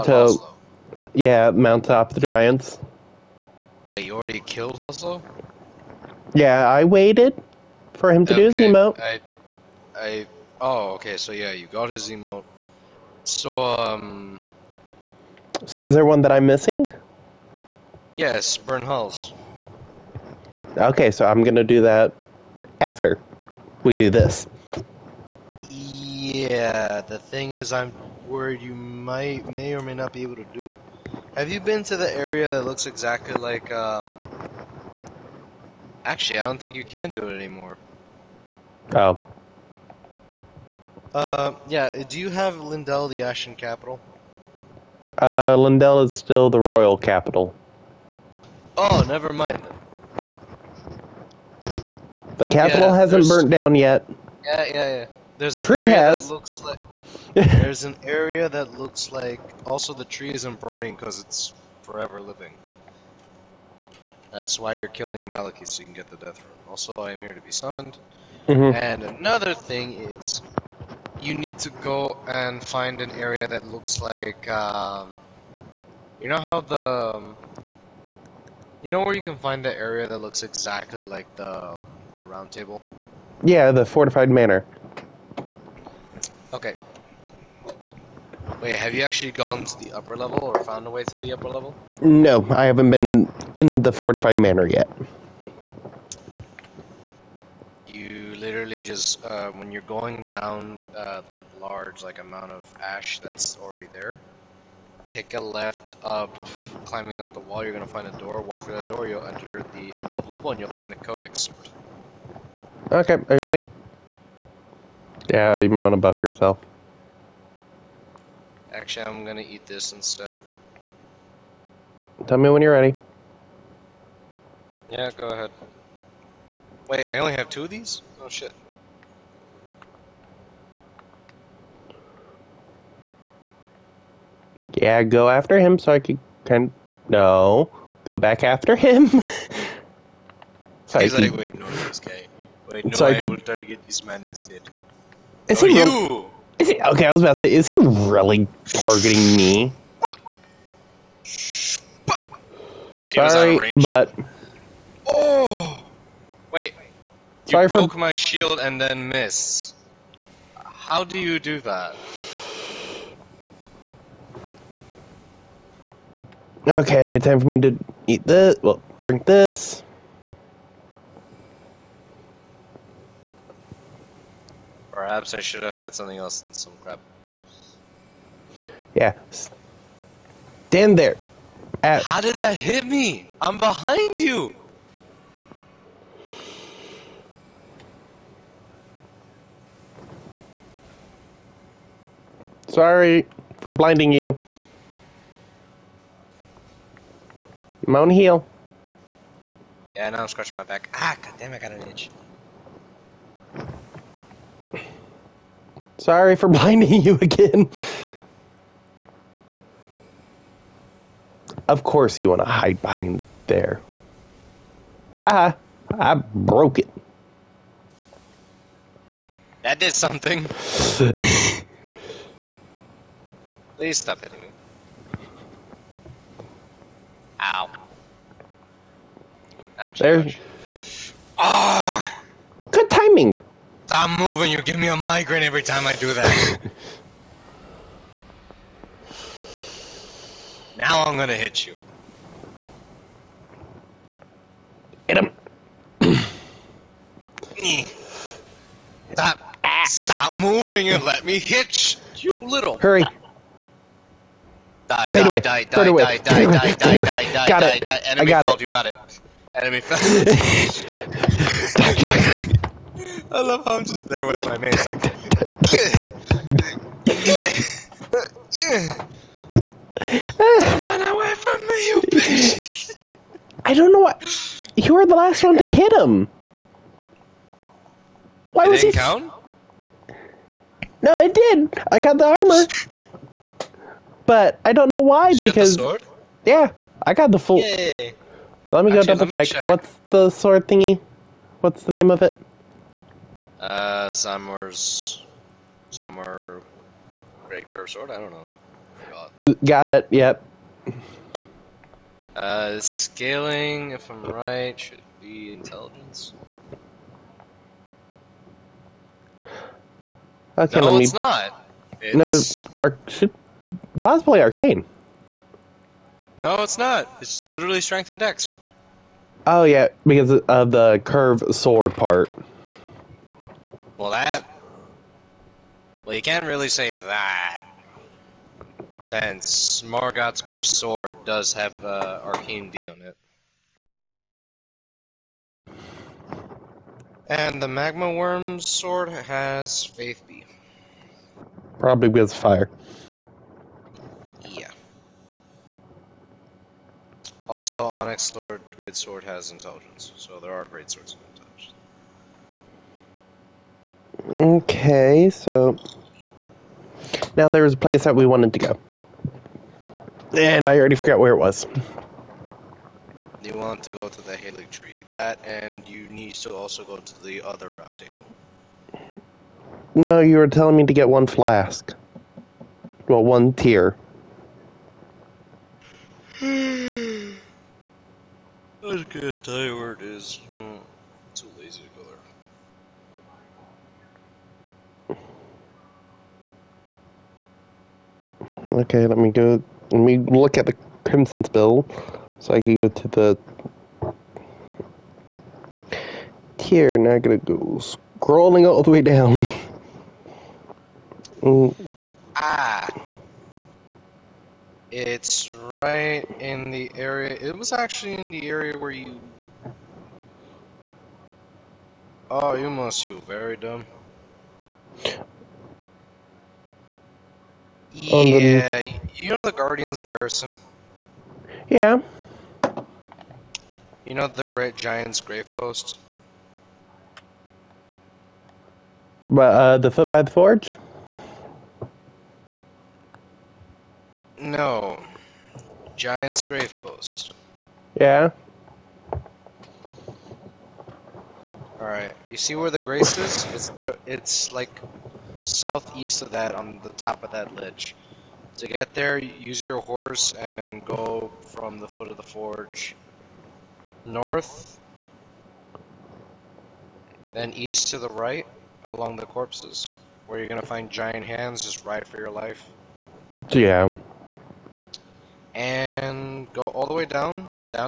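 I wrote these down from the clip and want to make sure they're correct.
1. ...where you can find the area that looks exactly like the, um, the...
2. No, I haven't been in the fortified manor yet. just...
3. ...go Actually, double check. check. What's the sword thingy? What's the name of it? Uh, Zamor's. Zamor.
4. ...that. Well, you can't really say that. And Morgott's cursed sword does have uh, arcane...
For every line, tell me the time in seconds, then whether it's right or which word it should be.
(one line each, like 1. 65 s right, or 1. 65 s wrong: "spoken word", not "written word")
1. 79 s right
2. 92 s right
3. 288 s right
4. 324 s right.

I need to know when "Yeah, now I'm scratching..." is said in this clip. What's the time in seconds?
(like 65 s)
199 s.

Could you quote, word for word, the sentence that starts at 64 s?
That's why you're killing Maliketh so you can get the death rune.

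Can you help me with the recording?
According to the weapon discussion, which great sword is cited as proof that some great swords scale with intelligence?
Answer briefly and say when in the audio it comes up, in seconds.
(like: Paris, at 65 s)
Onyx Lord Great Sword, at 347 s.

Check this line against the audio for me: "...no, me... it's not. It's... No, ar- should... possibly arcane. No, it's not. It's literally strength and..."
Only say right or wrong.
right.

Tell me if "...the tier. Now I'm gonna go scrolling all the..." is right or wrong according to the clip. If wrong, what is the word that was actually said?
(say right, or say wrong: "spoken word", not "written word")
right.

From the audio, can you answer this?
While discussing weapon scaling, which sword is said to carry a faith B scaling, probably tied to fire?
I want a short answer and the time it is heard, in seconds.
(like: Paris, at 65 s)
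Magma wyrm sword, at 337 s.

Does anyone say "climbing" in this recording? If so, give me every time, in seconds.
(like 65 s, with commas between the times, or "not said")
106 s.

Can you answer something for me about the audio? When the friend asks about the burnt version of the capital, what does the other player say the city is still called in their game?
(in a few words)
The royal capital.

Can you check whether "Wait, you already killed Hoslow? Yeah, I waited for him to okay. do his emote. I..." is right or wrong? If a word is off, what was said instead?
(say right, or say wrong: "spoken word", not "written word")
right.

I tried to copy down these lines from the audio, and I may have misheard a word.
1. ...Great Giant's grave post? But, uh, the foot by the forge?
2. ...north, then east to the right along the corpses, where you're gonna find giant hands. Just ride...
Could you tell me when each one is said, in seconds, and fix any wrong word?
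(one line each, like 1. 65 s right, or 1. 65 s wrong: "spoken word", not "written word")
1. 424 s right
2. 454 s right.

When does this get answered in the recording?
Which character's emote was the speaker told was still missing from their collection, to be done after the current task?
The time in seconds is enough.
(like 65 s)
18 s.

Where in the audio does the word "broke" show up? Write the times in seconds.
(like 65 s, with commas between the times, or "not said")
157 s, 216 s.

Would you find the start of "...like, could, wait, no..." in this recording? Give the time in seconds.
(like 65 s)
141 s.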